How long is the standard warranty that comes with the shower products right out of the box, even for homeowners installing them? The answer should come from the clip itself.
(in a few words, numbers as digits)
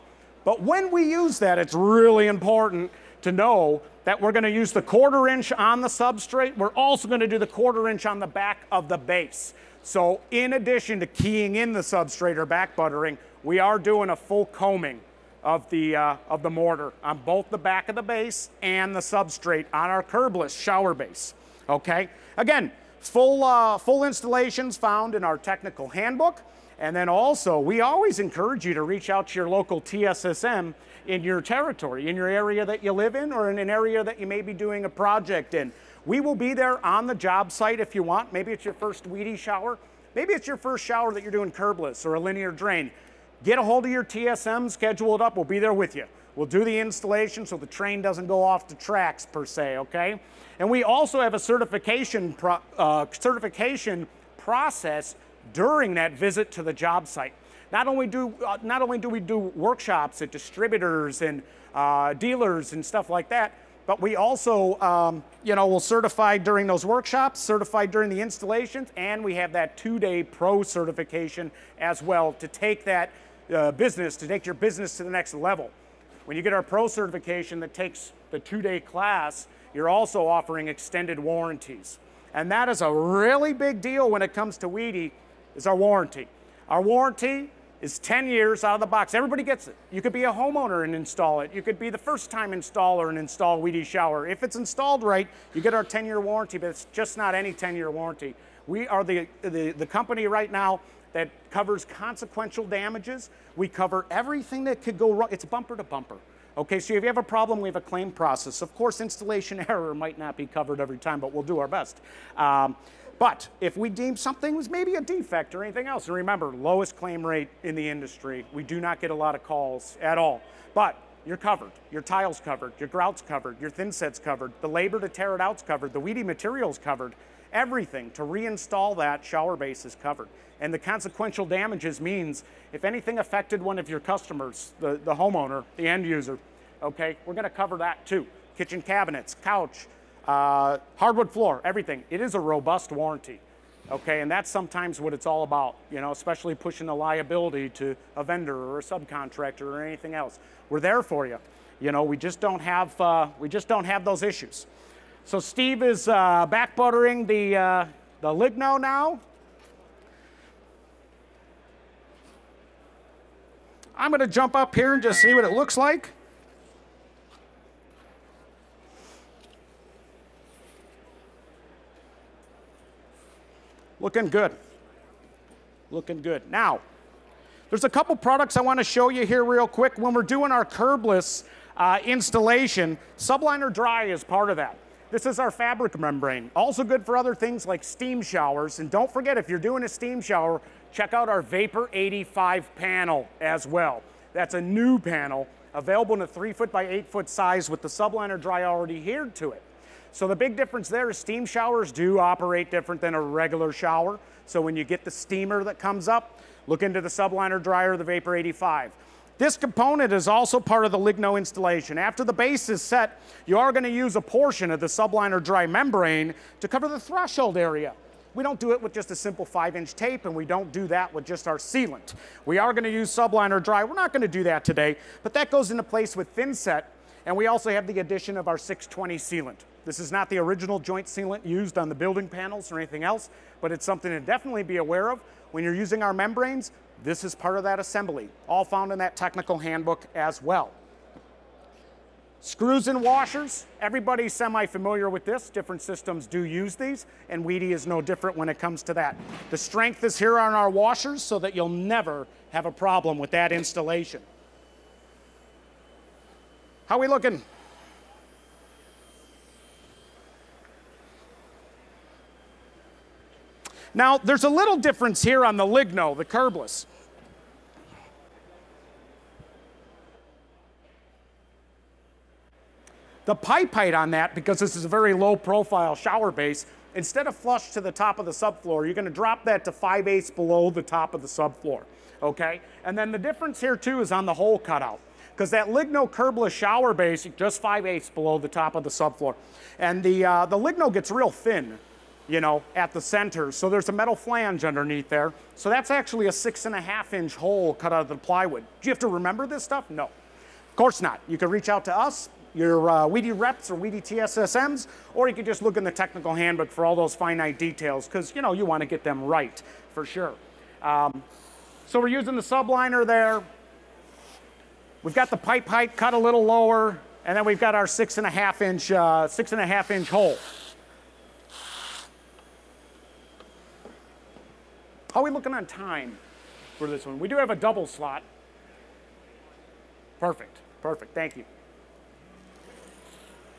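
10 years.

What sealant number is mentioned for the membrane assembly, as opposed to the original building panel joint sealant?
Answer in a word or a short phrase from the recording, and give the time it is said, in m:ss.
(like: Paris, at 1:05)
620, at 3:48.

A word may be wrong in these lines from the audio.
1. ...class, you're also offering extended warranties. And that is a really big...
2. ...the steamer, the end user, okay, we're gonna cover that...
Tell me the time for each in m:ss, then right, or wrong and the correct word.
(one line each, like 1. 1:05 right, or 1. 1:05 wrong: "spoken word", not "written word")
1. 1:18 right
2. 2:15 wrong: "homeowner", not "steamer".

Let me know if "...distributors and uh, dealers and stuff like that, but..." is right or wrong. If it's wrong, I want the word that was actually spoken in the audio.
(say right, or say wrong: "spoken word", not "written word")
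right.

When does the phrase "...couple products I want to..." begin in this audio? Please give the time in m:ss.
2:57.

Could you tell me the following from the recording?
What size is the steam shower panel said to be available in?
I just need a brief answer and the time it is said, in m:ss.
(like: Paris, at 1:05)
3 foot by 8 foot, at 3:16.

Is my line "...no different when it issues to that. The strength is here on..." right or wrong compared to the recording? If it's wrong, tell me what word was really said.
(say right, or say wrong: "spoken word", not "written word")
wrong: "comes", not "issues".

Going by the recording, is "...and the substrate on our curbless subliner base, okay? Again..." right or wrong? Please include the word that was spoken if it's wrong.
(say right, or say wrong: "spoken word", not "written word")
wrong: "shower", not "subliner".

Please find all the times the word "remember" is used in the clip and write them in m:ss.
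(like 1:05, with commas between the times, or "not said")
1:56, 4:59.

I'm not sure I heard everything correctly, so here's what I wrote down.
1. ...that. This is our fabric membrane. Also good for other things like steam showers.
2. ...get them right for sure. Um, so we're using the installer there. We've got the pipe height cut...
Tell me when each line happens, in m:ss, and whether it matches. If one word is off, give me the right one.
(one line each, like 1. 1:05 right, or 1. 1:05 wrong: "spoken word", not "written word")
1. 3:04 right
2. 5:08 wrong: "subliner", not "installer".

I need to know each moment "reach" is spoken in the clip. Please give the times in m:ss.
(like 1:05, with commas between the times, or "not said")
0:28, 5:01.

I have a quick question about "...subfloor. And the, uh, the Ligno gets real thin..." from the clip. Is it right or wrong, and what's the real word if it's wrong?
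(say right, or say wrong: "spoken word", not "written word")
right.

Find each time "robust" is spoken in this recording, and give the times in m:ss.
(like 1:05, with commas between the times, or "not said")
2:22.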